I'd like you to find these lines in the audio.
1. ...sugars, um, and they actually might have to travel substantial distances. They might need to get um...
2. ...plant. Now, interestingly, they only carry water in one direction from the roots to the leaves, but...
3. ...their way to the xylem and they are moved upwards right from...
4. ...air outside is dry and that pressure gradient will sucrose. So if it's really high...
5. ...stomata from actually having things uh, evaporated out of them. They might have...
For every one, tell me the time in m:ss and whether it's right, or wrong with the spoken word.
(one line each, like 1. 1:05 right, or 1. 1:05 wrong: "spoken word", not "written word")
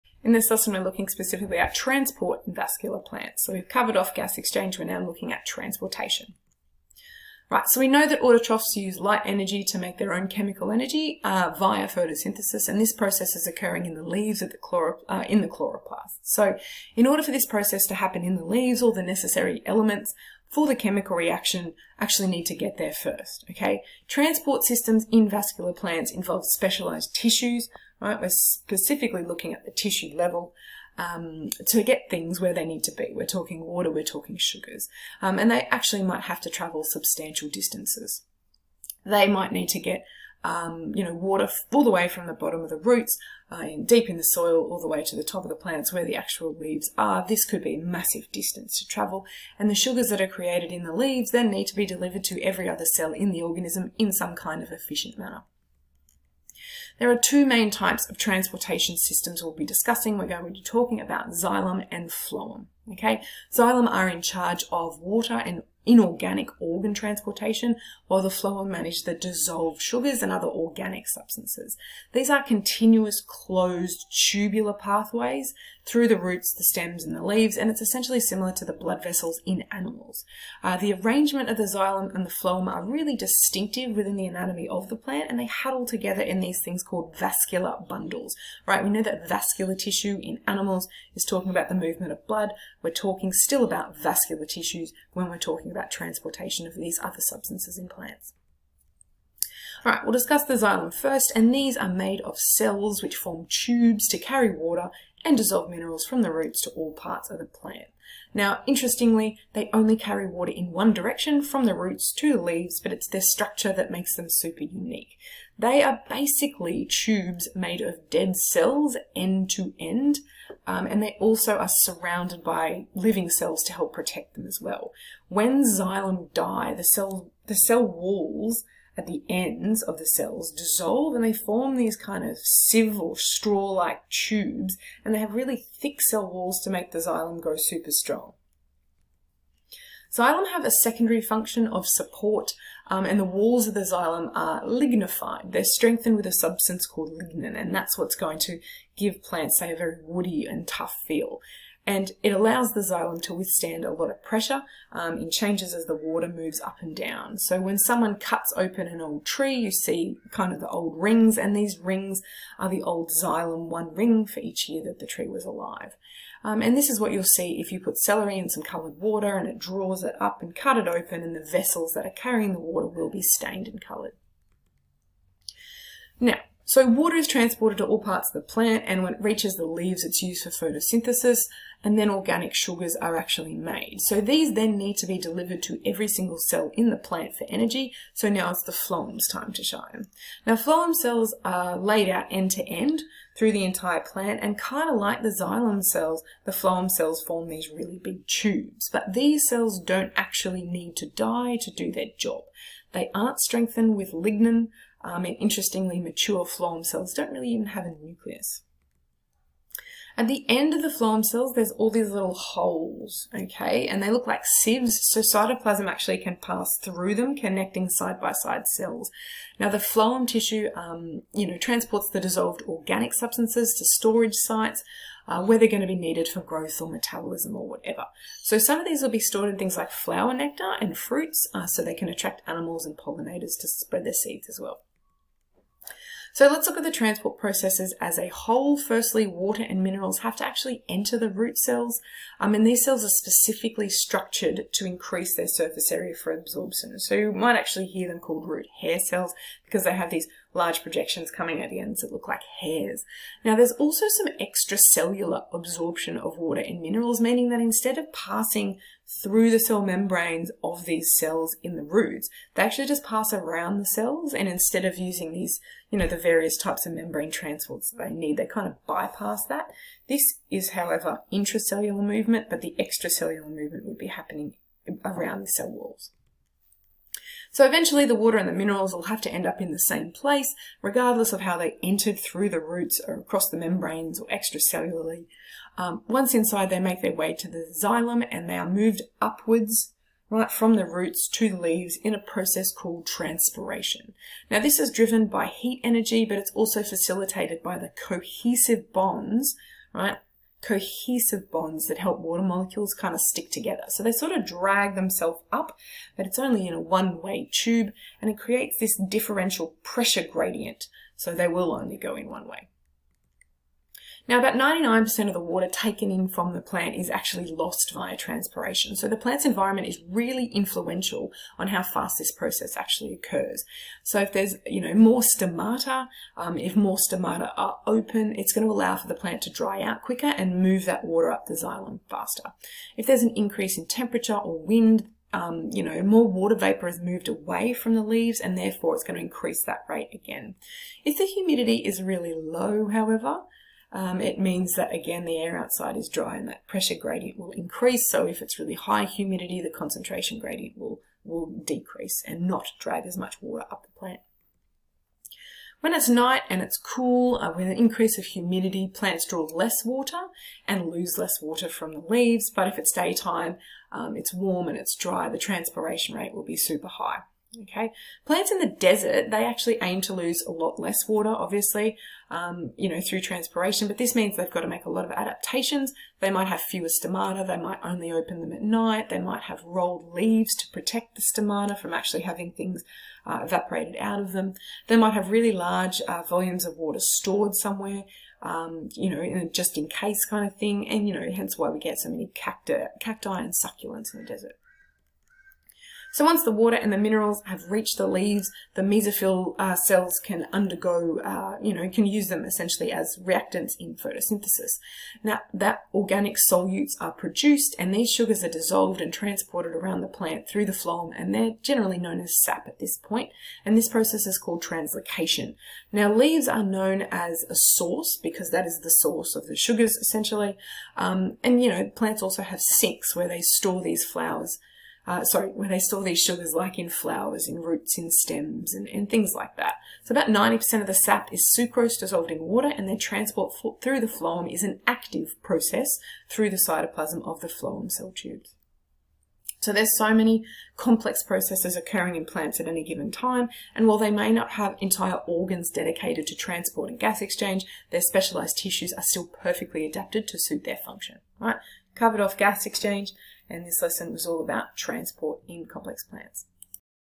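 1. 0:34 right
2. 1:47 right
3. 4:47 right
4. 5:45 wrong: "increase", not "sucrose"
5. 6:21 right.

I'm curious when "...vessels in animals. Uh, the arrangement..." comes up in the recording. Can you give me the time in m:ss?
1:19.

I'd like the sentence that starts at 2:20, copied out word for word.
Xylem have a secondary function of support um, and the walls of the xylem are lignified.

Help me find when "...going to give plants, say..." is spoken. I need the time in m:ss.
2:28.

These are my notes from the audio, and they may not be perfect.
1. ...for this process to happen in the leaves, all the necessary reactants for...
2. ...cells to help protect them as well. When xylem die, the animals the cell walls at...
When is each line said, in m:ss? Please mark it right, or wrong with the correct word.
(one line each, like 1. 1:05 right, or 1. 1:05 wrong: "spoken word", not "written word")
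1. 0:17 wrong: "elements", not "reactants"
2. 2:03 wrong: "cells", not "animals".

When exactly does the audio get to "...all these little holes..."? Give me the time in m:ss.
3:31.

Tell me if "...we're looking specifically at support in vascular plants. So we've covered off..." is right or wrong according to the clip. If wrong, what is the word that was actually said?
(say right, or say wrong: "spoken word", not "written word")
wrong: "transport", not "support".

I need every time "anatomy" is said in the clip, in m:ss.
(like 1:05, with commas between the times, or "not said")
1:24.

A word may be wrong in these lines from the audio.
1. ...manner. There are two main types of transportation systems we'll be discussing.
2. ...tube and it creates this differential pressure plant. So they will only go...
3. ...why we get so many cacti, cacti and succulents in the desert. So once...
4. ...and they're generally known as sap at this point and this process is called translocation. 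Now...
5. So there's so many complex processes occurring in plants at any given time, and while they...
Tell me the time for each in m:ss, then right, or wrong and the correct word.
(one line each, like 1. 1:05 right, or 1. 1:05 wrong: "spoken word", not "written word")
1. 0:55 right
2. 5:07 wrong: "gradient", not "plant"
3. 6:31 right
4. 6:51 right
5. 7:19 right.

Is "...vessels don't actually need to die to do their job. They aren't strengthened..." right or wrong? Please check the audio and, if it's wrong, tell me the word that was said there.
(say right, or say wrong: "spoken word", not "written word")
wrong: "cells", not "vessels".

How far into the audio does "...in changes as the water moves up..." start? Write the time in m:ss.
2:35.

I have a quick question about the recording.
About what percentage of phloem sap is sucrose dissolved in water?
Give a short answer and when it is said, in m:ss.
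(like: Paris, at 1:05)
90%, at 7:10.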